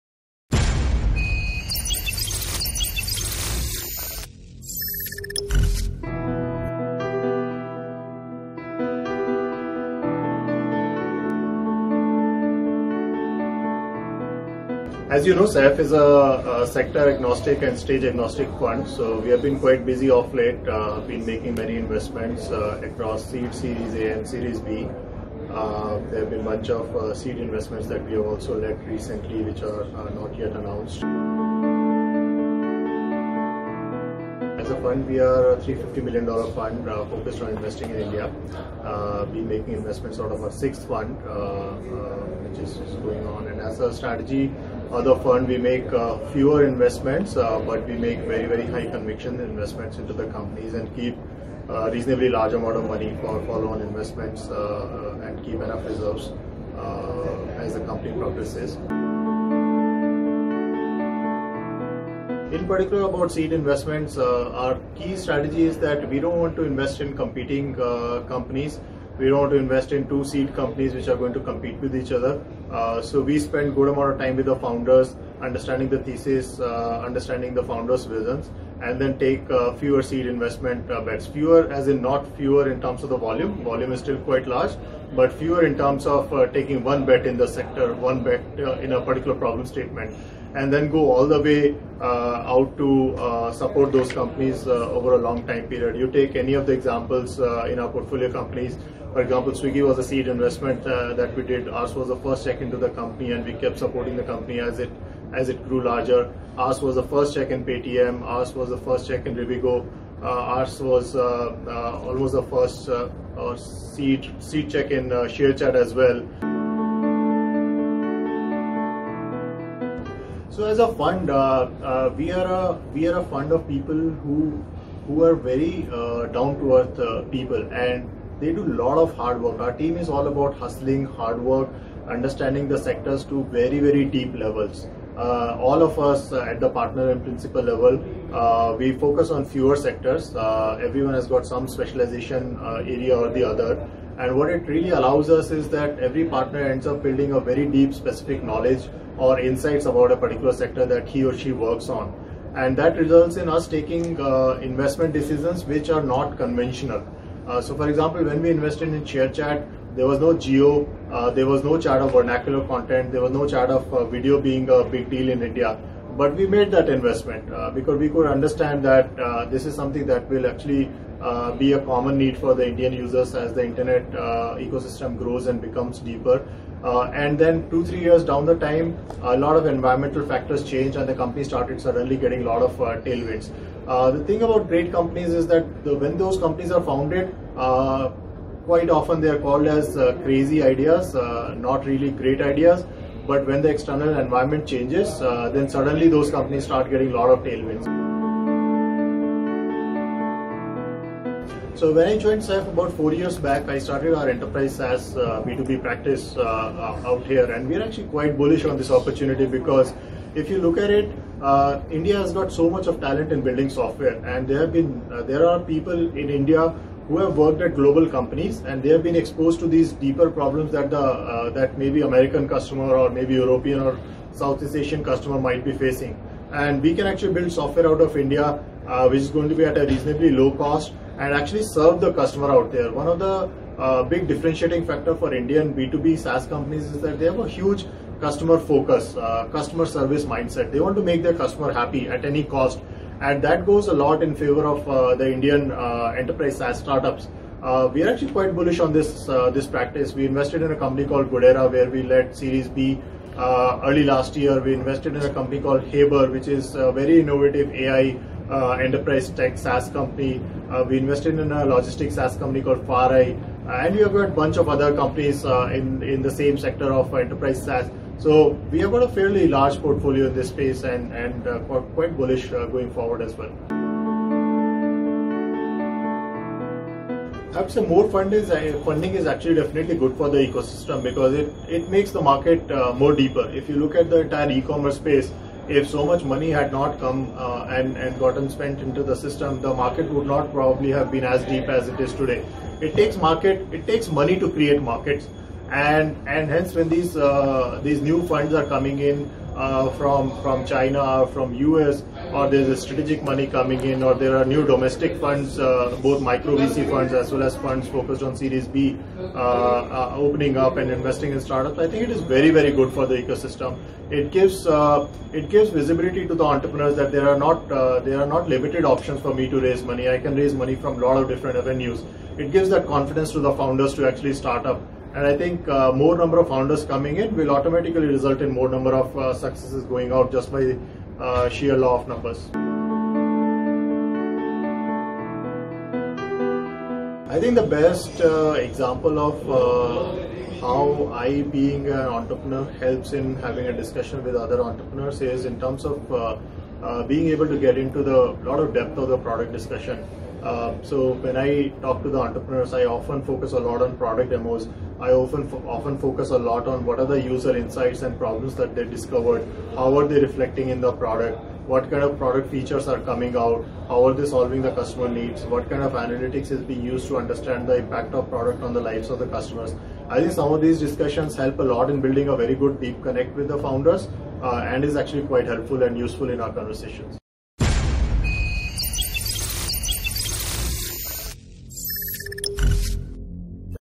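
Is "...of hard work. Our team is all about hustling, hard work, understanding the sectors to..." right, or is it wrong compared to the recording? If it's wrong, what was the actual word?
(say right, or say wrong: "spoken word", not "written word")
right.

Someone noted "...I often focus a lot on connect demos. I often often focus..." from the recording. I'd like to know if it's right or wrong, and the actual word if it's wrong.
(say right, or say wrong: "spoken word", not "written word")
wrong: "product", not "connect".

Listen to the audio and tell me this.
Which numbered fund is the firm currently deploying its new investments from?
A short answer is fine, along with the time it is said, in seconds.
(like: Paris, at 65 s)
sixth, at 40 s.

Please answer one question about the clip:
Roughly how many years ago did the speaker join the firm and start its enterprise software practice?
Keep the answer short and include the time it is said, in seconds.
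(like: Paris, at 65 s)
4, at 202 s.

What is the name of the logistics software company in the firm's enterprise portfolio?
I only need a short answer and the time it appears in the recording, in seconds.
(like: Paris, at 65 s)
FarEye, at 262 s.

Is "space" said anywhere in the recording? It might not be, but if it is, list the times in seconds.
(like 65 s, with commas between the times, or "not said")
270 s, 284 s.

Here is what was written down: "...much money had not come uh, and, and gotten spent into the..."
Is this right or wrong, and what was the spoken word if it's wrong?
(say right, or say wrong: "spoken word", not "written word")
right.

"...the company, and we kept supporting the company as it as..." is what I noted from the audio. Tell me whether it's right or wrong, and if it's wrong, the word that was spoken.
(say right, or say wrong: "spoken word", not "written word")
right.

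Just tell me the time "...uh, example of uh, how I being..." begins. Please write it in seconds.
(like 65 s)
338 s.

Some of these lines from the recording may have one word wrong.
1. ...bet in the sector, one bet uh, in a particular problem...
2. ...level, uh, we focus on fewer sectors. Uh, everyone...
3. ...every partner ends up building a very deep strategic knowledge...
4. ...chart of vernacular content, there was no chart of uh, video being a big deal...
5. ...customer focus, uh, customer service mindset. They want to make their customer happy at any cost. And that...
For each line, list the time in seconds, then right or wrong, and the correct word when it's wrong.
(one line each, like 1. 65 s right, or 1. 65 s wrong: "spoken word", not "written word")
1. 87 s right
2. 137 s right
3. 145 s wrong: "specific", not "strategic"
4. 161 s right
5. 238 s right.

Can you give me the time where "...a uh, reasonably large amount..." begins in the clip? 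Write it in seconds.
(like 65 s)
51 s.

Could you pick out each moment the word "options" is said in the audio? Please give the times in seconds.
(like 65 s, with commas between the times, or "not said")
318 s.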